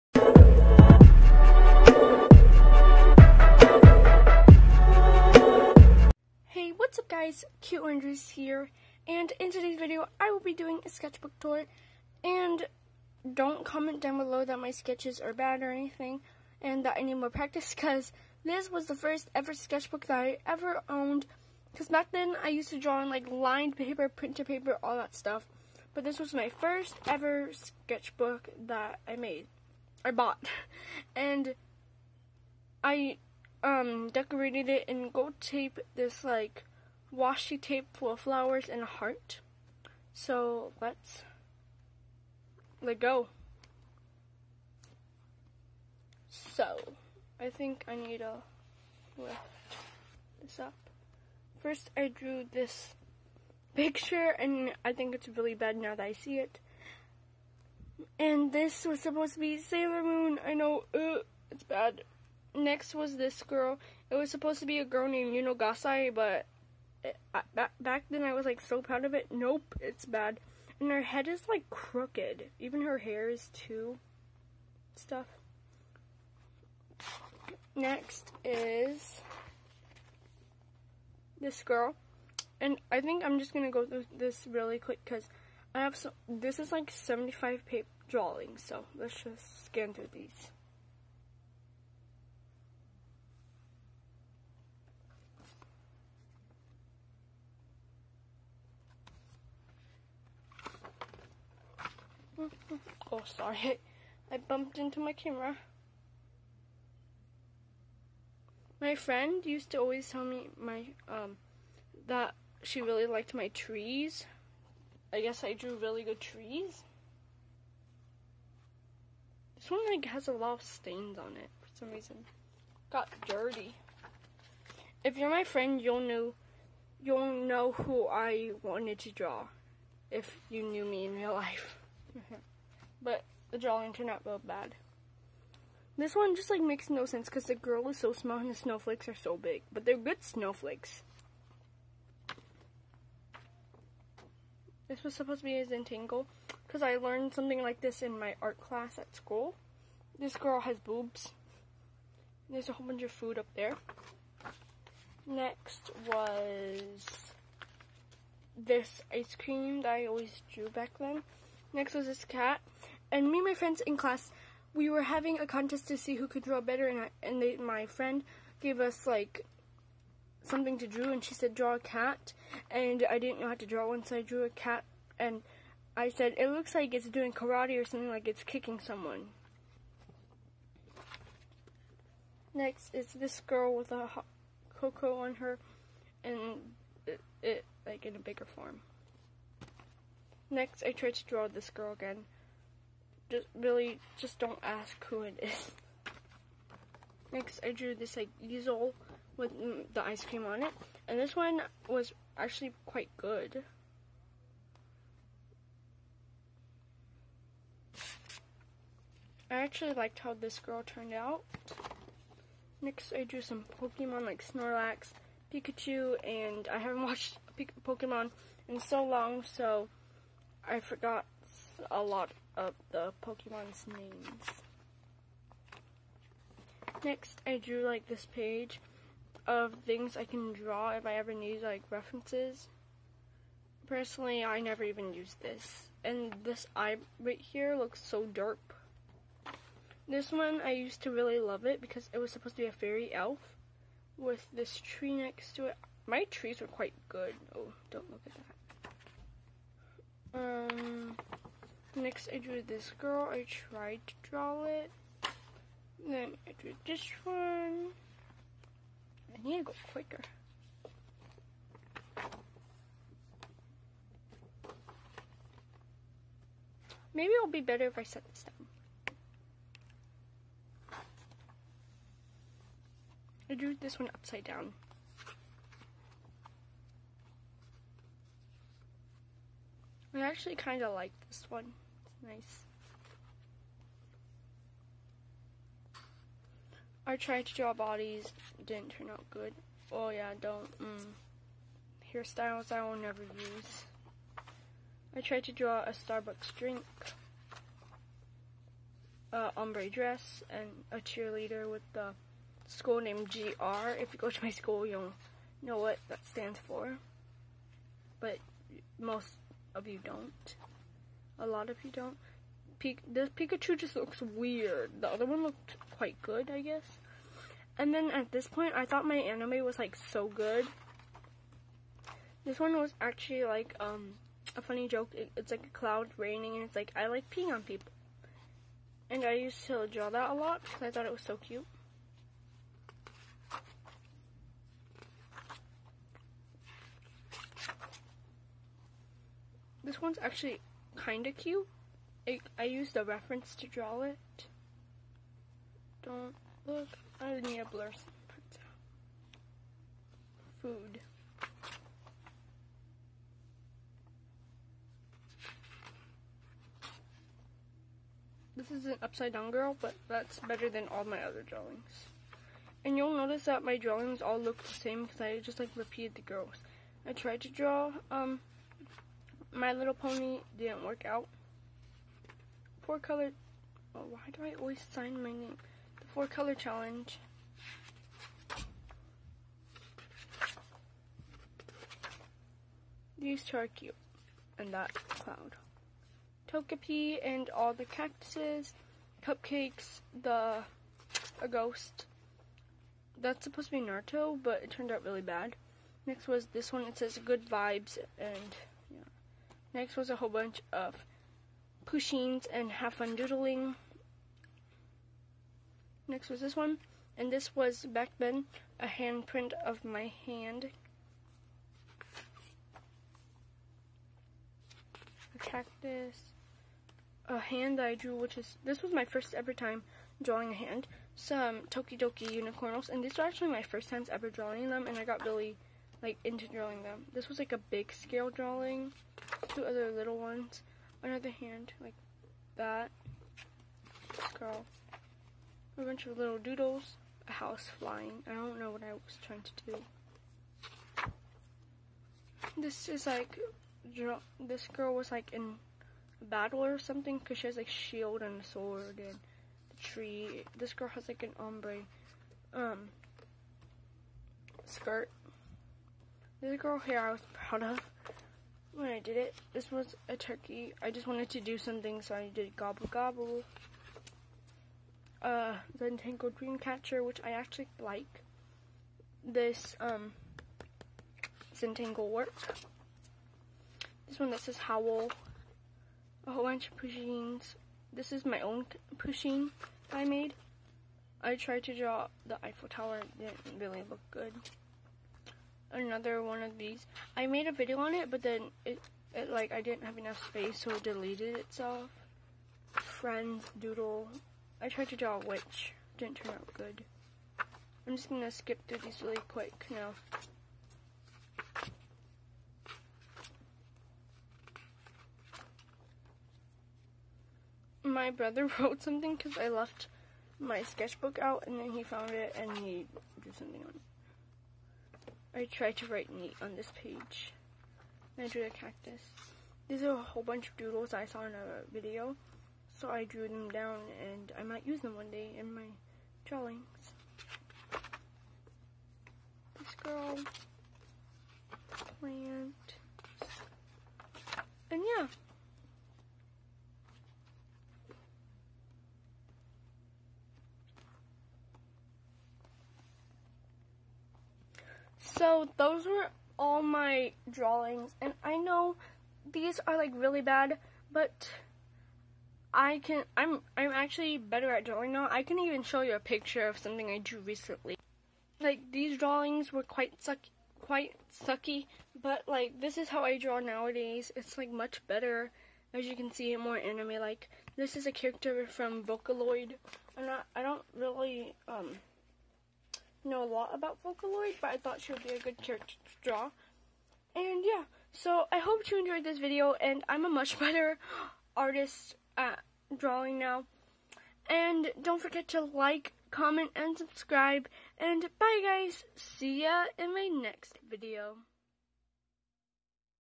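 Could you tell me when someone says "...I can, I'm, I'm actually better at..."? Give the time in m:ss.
9:12.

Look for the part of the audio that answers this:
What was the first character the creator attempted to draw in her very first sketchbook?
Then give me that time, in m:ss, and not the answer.
0:59.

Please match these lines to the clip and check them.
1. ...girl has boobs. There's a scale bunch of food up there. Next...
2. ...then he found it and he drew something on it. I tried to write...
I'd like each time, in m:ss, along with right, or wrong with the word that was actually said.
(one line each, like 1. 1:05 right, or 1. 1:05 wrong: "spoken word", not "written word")
1. 2:30 wrong: "whole", not "scale"
2. 8:31 right.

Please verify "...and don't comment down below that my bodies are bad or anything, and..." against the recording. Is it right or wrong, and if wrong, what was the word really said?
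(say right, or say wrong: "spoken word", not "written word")
wrong: "sketches", not "bodies".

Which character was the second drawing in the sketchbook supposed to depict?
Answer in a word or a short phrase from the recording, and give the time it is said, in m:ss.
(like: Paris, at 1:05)
Yuno Gasai, at 1:05.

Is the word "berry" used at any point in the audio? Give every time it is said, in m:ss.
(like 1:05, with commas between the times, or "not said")
not said.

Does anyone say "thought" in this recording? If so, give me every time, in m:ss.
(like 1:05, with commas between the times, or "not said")
5:18, 5:30, 9:34.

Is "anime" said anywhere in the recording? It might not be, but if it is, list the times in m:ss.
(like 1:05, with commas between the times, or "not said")
5:19, 9:26.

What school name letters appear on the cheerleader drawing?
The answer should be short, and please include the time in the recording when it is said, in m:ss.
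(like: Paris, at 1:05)
GR, at 5:03.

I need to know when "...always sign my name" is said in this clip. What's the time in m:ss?
6:14.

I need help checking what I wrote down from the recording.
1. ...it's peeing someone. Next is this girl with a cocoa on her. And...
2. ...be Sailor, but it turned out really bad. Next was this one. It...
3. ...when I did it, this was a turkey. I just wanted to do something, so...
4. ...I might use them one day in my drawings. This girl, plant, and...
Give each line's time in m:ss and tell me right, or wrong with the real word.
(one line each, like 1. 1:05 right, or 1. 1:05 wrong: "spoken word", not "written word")
1. 2:58 wrong: "kicking", not "peeing"
2. 6:33 wrong: "Naruto", not "Sailor"
3. 7:38 right
4. 8:44 right.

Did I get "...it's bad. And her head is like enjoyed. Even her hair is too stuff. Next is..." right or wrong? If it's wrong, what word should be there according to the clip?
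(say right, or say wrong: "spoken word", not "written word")
wrong: "crooked", not "enjoyed".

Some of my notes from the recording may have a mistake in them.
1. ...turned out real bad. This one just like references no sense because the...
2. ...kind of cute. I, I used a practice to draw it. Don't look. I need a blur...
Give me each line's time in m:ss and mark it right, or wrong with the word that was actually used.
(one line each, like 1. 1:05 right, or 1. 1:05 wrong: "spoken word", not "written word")
1. 2:13 wrong: "makes", not "references"
2. 5:40 wrong: "reference", not "practice".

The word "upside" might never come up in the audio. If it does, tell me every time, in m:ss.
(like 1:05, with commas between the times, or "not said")
4:34, 5:59.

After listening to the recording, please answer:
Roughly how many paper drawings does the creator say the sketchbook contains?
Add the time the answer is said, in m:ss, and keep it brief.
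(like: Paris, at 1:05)
75, at 1:26.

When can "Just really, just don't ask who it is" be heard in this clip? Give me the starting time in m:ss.
3:13.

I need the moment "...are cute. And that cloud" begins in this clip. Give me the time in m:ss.
6:23.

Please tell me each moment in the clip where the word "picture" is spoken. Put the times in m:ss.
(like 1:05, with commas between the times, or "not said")
0:53, 9:15.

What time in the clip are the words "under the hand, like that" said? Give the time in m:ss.
7:11.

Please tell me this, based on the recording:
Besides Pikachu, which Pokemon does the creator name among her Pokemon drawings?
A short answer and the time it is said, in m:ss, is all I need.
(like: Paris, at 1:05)
Snorlax, at 3:34.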